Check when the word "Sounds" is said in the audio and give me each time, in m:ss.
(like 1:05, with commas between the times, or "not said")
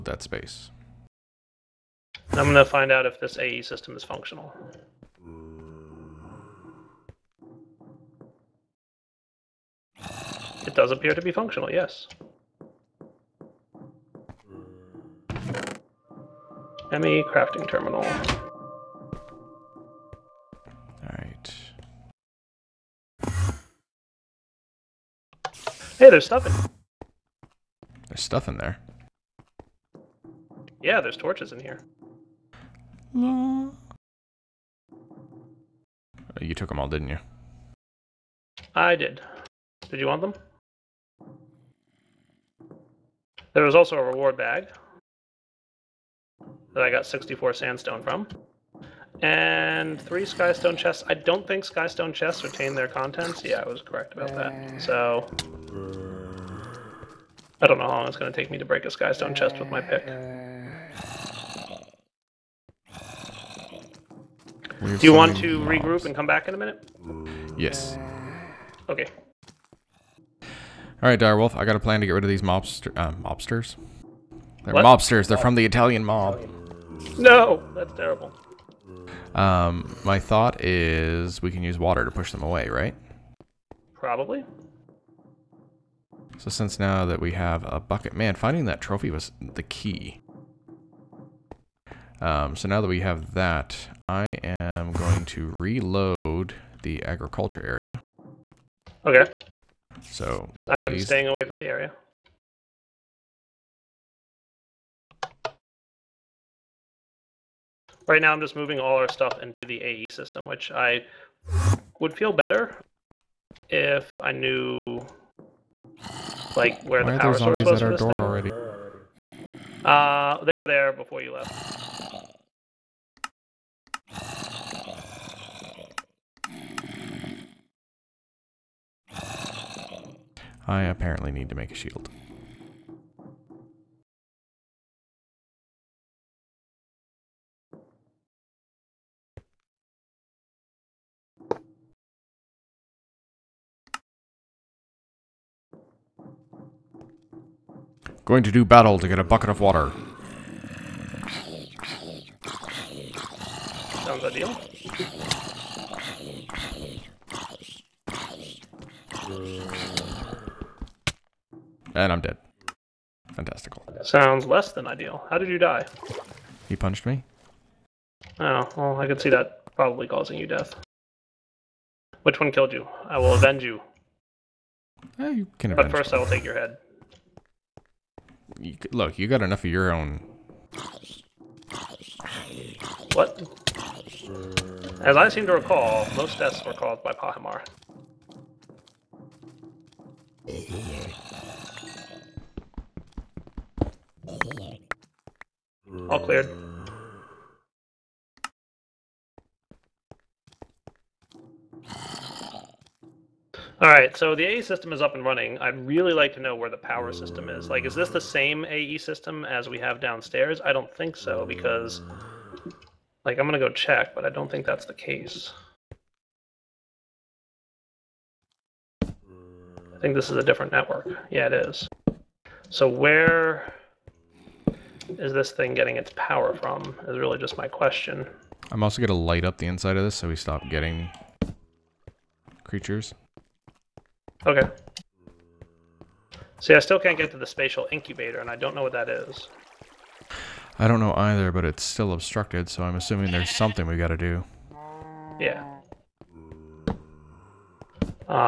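2:34, 2:44.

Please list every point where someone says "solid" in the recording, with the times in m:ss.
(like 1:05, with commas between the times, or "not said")
not said.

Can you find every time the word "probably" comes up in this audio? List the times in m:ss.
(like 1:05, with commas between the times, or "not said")
1:23, 2:49.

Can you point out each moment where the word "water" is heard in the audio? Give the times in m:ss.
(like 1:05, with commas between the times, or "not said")
1:21, 2:29.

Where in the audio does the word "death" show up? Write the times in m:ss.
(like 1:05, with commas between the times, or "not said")
2:50, 3:06.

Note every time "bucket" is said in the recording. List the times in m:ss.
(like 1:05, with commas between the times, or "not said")
1:27, 2:29.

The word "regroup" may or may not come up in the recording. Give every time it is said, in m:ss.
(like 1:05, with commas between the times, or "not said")
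1:05.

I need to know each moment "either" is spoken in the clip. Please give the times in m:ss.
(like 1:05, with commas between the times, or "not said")
4:01.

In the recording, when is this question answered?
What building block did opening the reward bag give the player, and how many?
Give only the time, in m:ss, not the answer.
0:47.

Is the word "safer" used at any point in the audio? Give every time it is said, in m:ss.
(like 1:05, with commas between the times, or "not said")
not said.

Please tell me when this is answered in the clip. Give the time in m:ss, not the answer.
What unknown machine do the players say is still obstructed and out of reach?
3:57.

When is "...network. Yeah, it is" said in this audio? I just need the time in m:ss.
3:40.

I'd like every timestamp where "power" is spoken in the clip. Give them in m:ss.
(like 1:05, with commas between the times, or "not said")
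1:57, 3:26, 3:46.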